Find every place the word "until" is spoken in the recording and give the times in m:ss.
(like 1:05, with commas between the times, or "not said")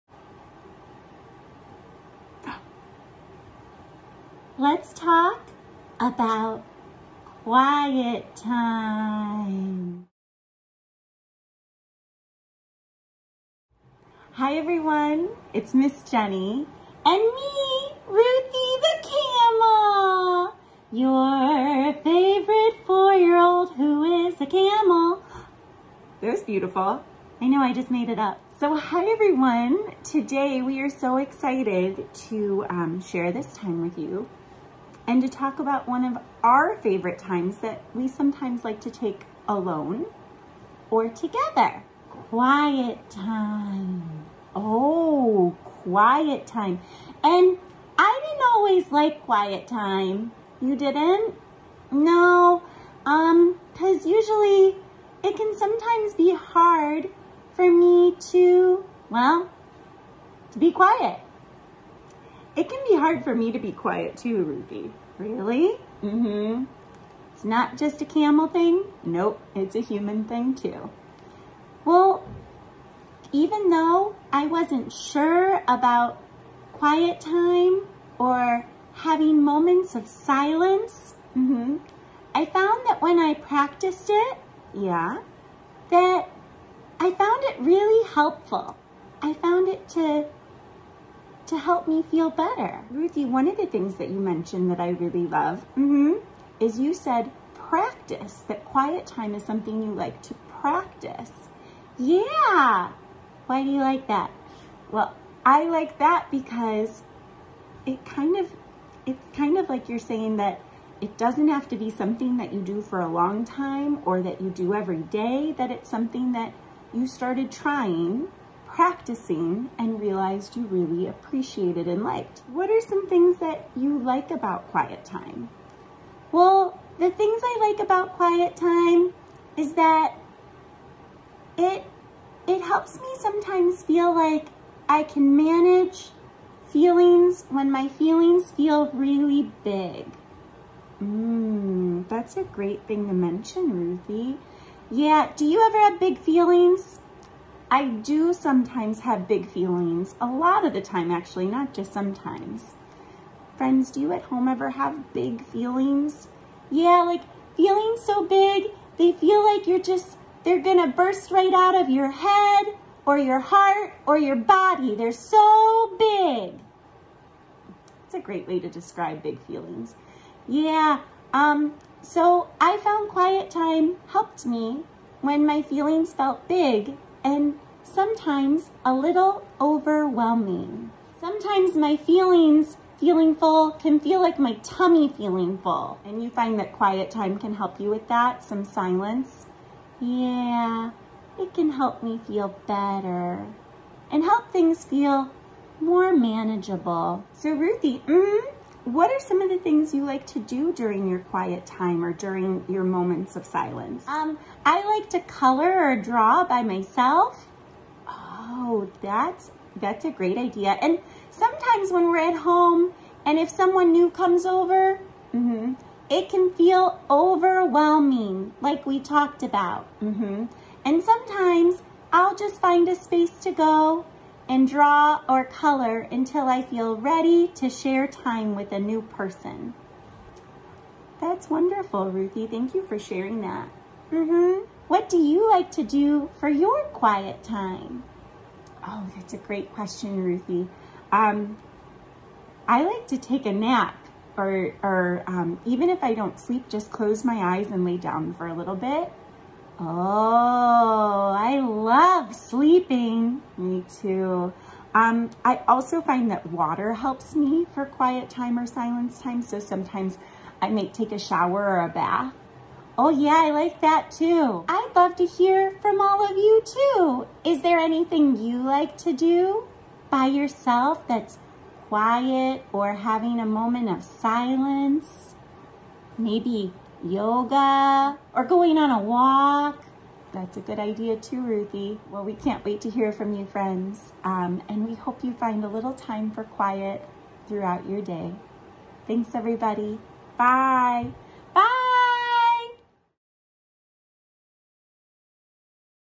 3:45.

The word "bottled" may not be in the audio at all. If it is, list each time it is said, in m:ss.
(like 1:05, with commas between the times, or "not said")
not said.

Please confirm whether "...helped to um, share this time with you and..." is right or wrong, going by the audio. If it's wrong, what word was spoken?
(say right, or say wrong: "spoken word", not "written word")
wrong: "excited", not "helped".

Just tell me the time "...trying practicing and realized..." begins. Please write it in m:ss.
1:57.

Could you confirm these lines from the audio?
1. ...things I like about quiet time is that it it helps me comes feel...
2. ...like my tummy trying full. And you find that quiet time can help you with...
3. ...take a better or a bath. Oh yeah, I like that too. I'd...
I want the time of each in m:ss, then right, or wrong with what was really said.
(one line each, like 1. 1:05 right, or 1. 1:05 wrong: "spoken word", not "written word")
1. 2:07 wrong: "sometimes", not "comes"
2. 3:04 wrong: "feeling", not "trying"
3. 4:20 wrong: "shower", not "better".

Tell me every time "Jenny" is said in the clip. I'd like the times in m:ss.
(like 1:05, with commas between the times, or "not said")
0:16.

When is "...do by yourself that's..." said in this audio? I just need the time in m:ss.
4:29.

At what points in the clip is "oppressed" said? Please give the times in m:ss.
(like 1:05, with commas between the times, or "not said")
not said.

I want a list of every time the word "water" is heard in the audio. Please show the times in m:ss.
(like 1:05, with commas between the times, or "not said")
4:16.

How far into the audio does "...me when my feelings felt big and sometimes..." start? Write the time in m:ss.
2:54.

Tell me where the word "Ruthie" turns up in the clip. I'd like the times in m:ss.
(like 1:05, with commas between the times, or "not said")
0:18, 1:04, 1:32, 2:23, 3:17, 3:52, 4:00, 4:41.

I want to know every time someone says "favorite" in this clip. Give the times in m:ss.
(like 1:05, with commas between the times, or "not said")
0:22, 0:36.